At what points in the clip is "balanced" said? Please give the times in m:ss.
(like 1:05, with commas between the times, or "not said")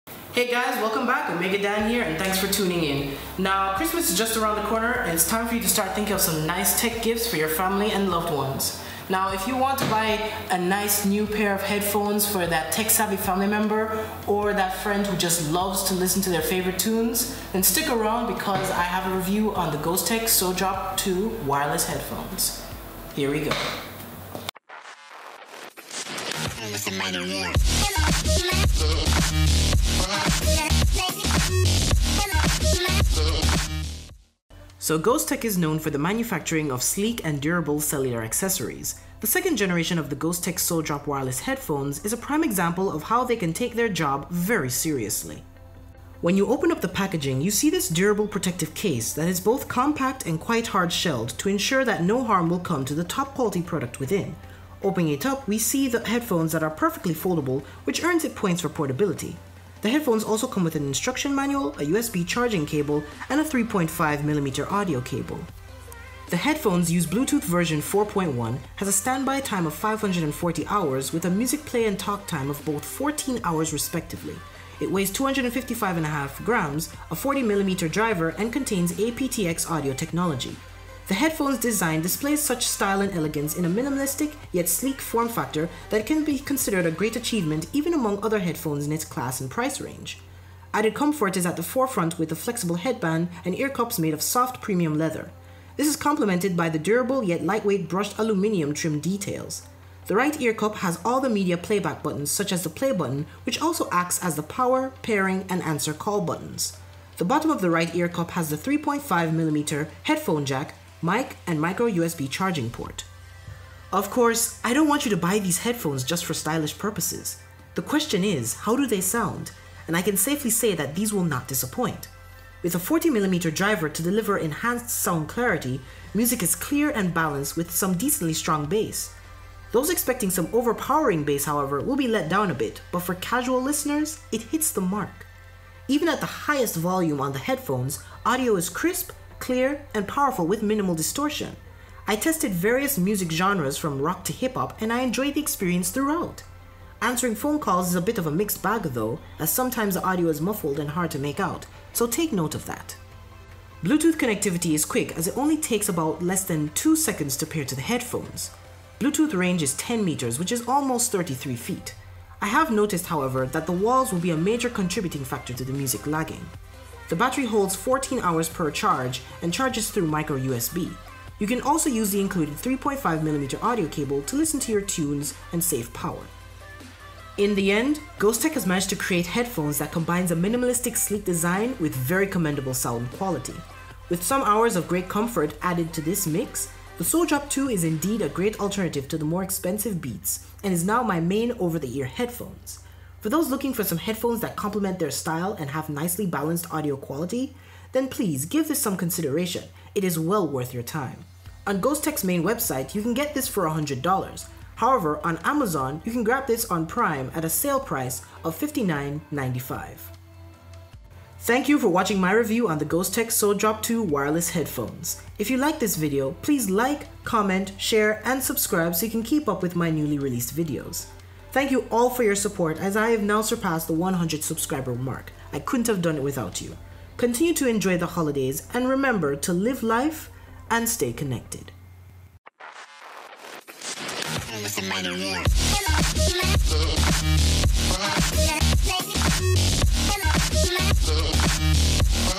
2:07, 3:16.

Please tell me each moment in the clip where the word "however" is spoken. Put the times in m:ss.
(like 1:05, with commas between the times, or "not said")
2:11, 2:43, 3:24.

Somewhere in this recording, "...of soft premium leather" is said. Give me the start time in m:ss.
1:34.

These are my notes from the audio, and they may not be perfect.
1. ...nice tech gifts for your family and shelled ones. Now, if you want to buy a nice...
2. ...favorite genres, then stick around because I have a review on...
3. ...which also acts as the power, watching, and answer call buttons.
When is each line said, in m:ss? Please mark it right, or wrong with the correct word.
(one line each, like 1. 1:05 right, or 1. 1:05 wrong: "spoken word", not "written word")
1. 0:06 wrong: "loved", not "shelled"
2. 0:16 wrong: "tunes", not "genres"
3. 1:43 wrong: "pairing", not "watching".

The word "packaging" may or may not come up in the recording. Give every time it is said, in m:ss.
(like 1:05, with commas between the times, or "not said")
0:46.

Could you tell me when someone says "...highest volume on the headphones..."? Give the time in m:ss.
2:16.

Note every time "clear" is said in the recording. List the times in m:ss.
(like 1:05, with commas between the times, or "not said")
2:06, 2:19.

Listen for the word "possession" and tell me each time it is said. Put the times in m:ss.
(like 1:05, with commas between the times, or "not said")
not said.